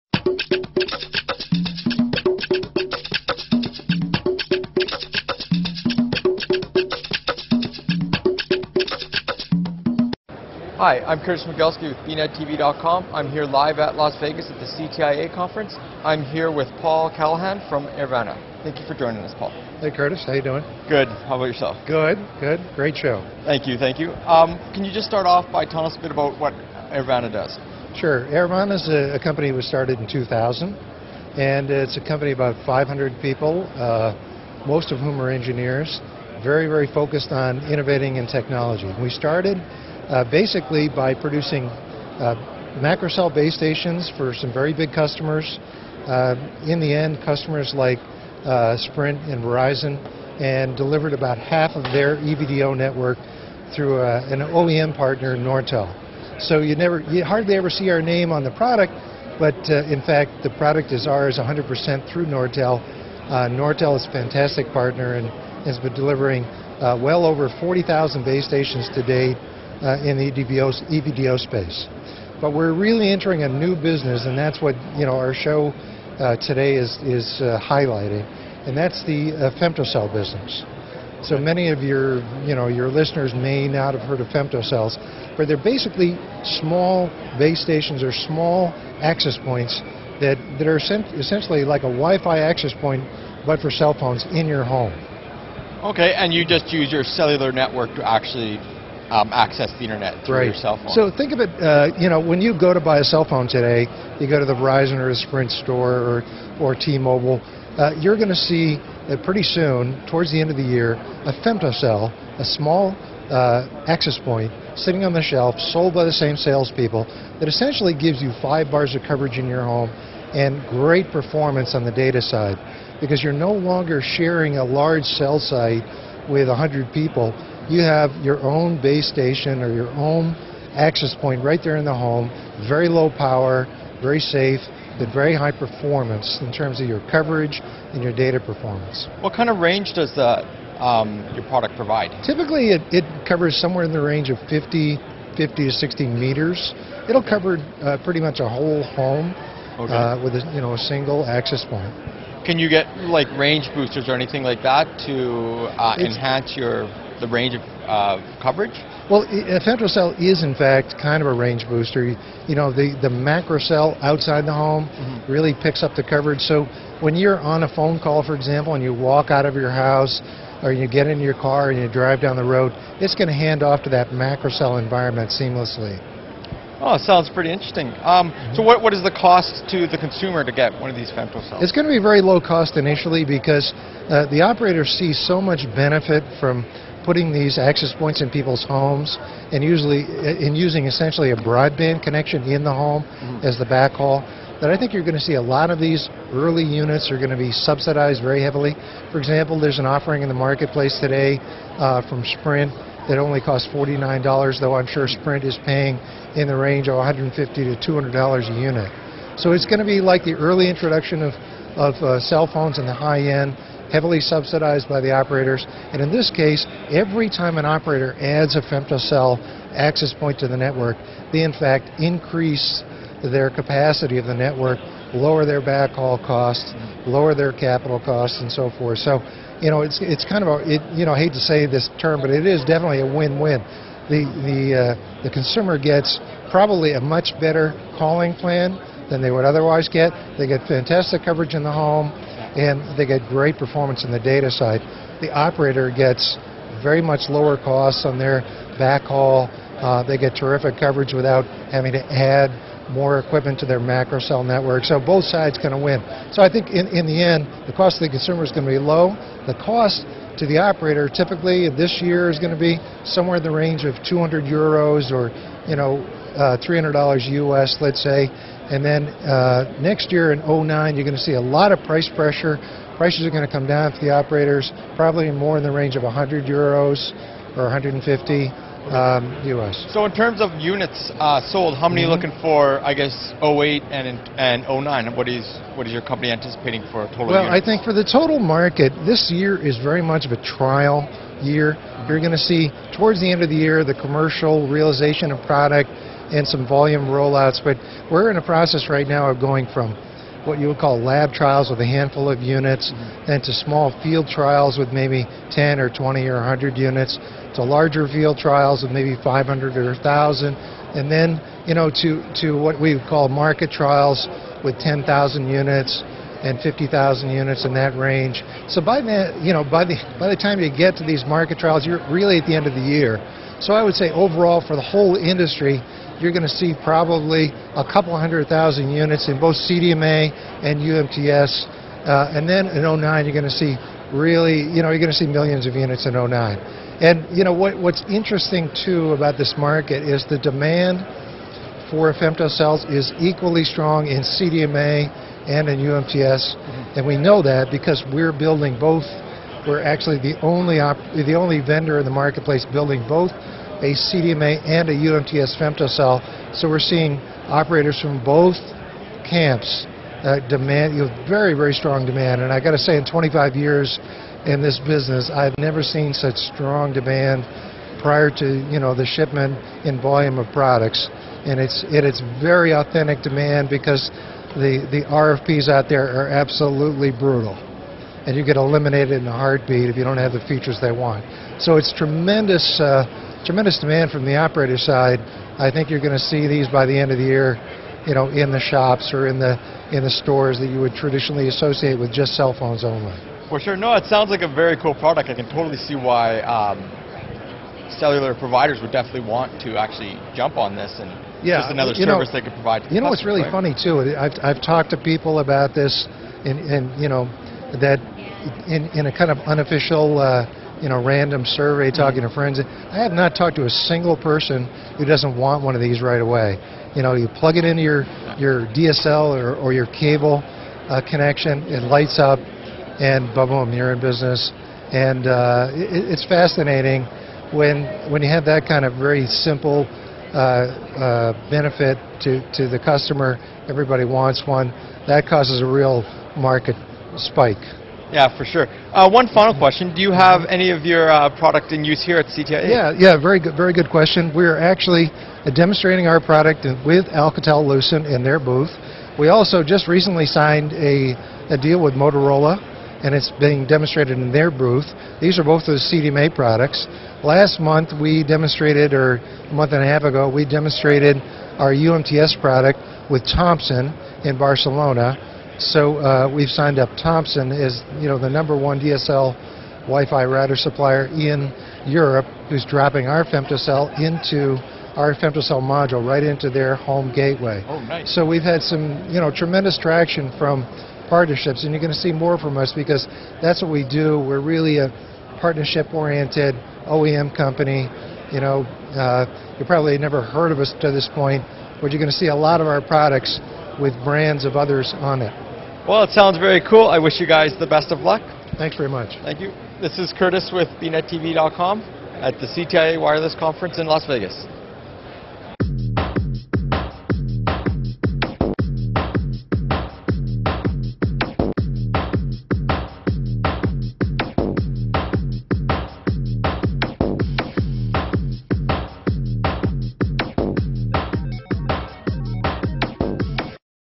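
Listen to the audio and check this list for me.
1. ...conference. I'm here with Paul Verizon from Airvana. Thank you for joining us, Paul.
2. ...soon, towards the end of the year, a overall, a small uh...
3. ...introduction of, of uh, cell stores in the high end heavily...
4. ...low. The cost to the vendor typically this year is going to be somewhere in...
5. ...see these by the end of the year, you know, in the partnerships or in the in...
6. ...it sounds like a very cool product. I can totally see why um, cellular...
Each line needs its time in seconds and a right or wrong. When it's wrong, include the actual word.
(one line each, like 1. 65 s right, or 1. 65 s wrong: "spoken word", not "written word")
1. 15 s wrong: "Callahan", not "Verizon"
2. 109 s wrong: "femtocell", not "overall"
3. 210 s wrong: "phones", not "stores"
4. 258 s wrong: "operator", not "vendor"
5. 386 s wrong: "shops", not "partnerships"
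6. 393 s right.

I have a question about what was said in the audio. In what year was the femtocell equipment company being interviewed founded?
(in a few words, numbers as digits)
2000.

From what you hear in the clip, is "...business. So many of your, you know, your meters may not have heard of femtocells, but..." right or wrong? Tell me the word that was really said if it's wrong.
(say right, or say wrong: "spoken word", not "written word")
wrong: "listeners", not "meters".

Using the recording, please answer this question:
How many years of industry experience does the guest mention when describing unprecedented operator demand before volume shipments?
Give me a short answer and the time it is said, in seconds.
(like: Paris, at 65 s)
25 years, at 363 s.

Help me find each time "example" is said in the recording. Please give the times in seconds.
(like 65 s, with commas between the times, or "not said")
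168 s, 199 s.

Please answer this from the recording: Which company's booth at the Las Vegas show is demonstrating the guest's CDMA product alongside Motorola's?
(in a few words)
Alcatel-Lucent.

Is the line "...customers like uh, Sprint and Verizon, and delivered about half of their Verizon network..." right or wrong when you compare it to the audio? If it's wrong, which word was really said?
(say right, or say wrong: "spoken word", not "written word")
wrong: "EVDO", not "Verizon".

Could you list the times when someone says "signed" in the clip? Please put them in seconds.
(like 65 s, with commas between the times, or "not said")
450 s, 466 s.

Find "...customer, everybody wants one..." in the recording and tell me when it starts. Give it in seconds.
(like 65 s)
432 s.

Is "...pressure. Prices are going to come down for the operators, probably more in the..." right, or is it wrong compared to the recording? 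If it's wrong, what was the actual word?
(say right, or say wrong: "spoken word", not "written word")
right.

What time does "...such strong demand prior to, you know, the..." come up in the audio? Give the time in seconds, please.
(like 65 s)
366 s.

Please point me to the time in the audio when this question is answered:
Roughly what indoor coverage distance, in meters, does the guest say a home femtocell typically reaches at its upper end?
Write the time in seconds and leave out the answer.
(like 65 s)
145 s.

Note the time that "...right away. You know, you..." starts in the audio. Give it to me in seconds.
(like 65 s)
416 s.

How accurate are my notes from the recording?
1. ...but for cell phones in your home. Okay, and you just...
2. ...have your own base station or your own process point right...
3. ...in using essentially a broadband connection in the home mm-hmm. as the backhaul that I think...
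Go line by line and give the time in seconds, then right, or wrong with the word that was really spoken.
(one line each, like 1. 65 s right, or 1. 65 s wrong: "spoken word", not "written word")
1. 93 s right
2. 127 s wrong: "access", not "process"
3. 190 s right.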